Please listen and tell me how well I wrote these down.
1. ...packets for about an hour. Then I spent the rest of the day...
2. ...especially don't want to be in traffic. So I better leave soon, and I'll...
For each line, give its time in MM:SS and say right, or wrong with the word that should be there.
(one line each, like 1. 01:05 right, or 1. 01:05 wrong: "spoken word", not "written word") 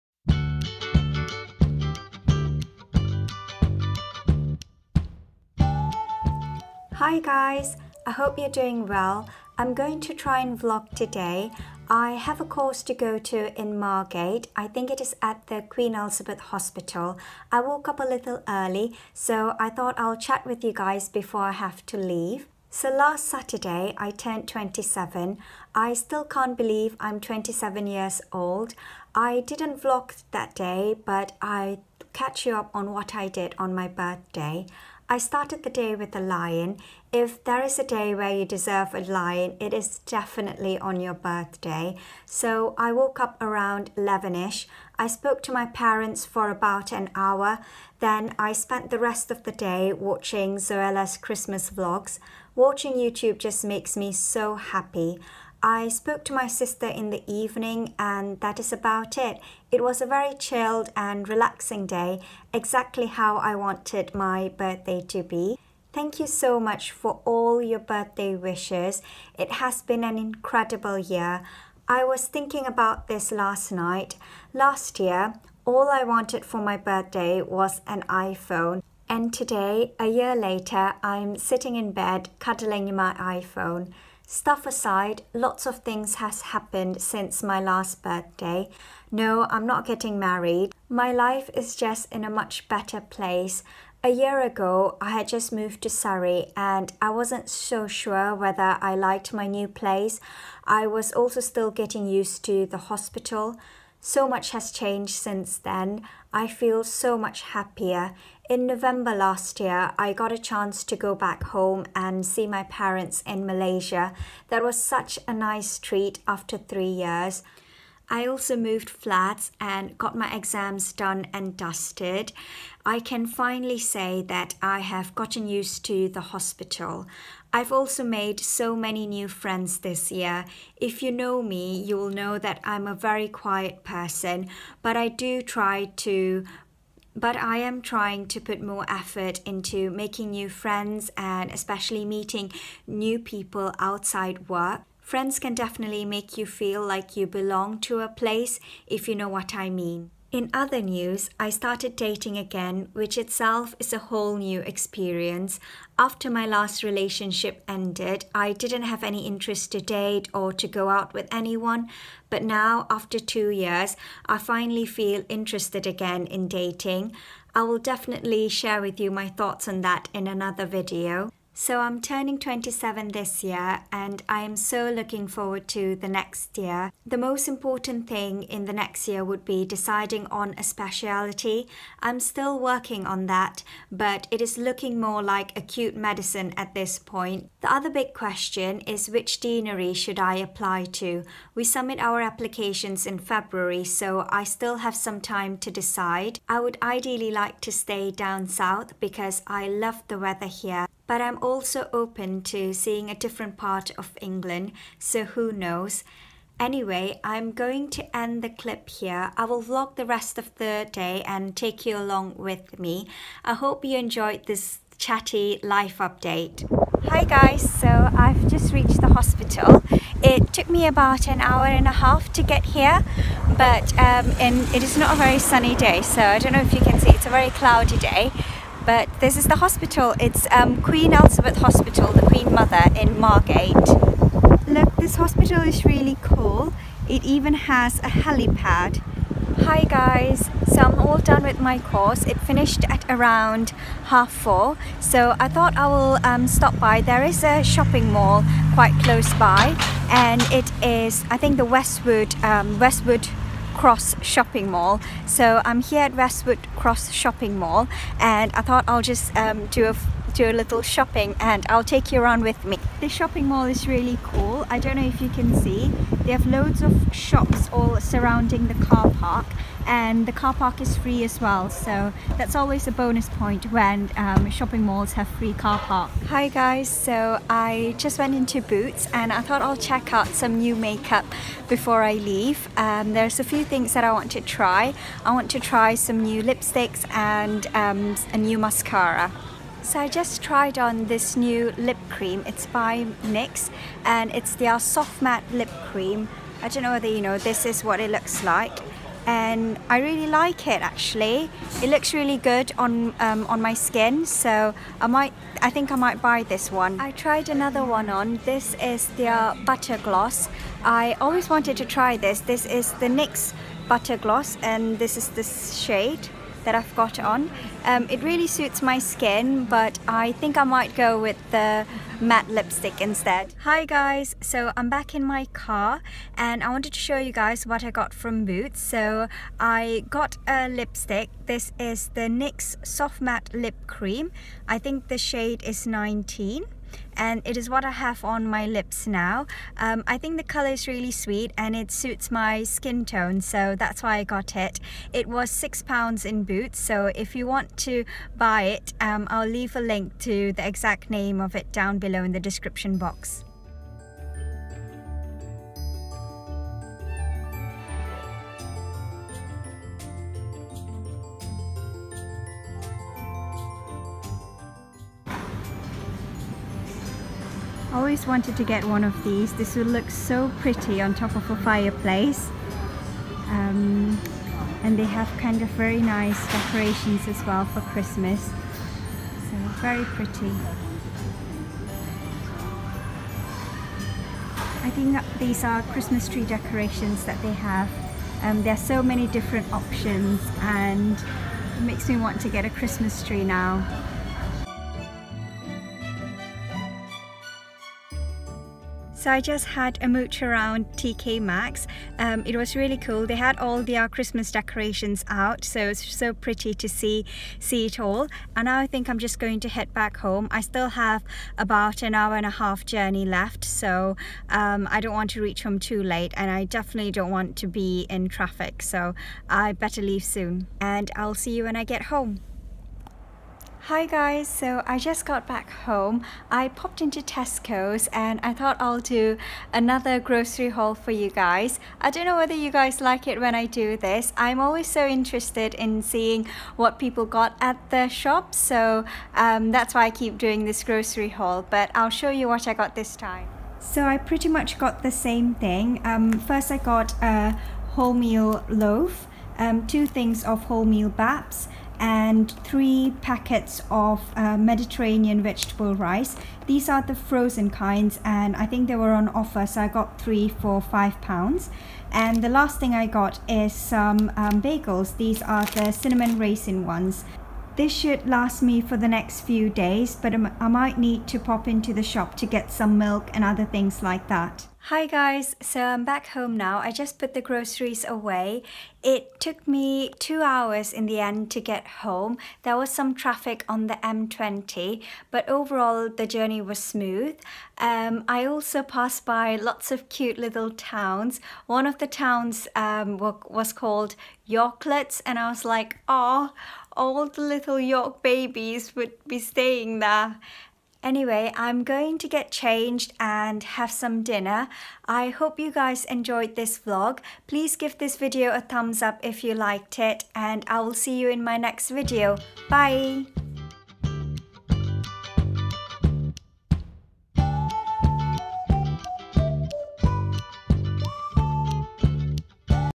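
1. 00:45 wrong: "parents", not "packets"
2. 06:56 wrong: "definitely", not "especially".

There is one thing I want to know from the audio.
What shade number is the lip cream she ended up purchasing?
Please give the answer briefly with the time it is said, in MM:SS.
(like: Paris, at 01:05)
19, at 05:35.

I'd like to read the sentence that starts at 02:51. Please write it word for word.
So I'm turning 27 this year and I am so looking forward to the next year.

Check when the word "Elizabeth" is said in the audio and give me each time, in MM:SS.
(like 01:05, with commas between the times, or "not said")
00:15, 03:51.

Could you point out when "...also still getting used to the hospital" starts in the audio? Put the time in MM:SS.
01:41.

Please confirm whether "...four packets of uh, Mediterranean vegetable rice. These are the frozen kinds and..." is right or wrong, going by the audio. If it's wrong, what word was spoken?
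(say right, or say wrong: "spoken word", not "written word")
wrong: "three", not "four".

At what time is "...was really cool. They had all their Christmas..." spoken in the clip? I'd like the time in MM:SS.
06:42.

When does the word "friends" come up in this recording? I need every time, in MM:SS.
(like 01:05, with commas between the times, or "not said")
02:09, 02:20, 02:25.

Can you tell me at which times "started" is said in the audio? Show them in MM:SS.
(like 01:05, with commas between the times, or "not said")
00:35, 02:31.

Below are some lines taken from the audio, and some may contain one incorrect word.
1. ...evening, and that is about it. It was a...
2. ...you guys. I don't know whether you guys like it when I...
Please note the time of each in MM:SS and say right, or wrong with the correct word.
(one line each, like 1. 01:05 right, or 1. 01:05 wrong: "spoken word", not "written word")
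1. 00:57 right
2. 07:11 right.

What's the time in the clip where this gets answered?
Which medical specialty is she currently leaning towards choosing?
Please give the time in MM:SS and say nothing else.
03:05.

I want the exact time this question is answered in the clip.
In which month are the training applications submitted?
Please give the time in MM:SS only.
03:13.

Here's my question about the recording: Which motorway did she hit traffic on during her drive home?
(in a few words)
M20.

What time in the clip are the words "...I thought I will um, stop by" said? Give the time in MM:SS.
04:05.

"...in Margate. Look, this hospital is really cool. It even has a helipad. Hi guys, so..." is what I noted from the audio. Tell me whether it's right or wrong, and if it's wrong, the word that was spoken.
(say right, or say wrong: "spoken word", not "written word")
right.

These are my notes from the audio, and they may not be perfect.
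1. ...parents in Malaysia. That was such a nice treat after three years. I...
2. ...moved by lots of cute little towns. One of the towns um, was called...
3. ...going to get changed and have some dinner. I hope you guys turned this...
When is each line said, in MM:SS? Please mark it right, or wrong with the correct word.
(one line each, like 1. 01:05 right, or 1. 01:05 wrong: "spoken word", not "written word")
1. 01:52 right
2. 08:08 wrong: "passed", not "moved"
3. 08:21 wrong: "enjoyed", not "turned".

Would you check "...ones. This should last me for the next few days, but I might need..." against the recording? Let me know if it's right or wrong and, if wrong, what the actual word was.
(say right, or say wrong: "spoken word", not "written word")
right.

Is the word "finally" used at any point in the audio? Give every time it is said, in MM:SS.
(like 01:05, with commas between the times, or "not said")
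02:03, 02:44.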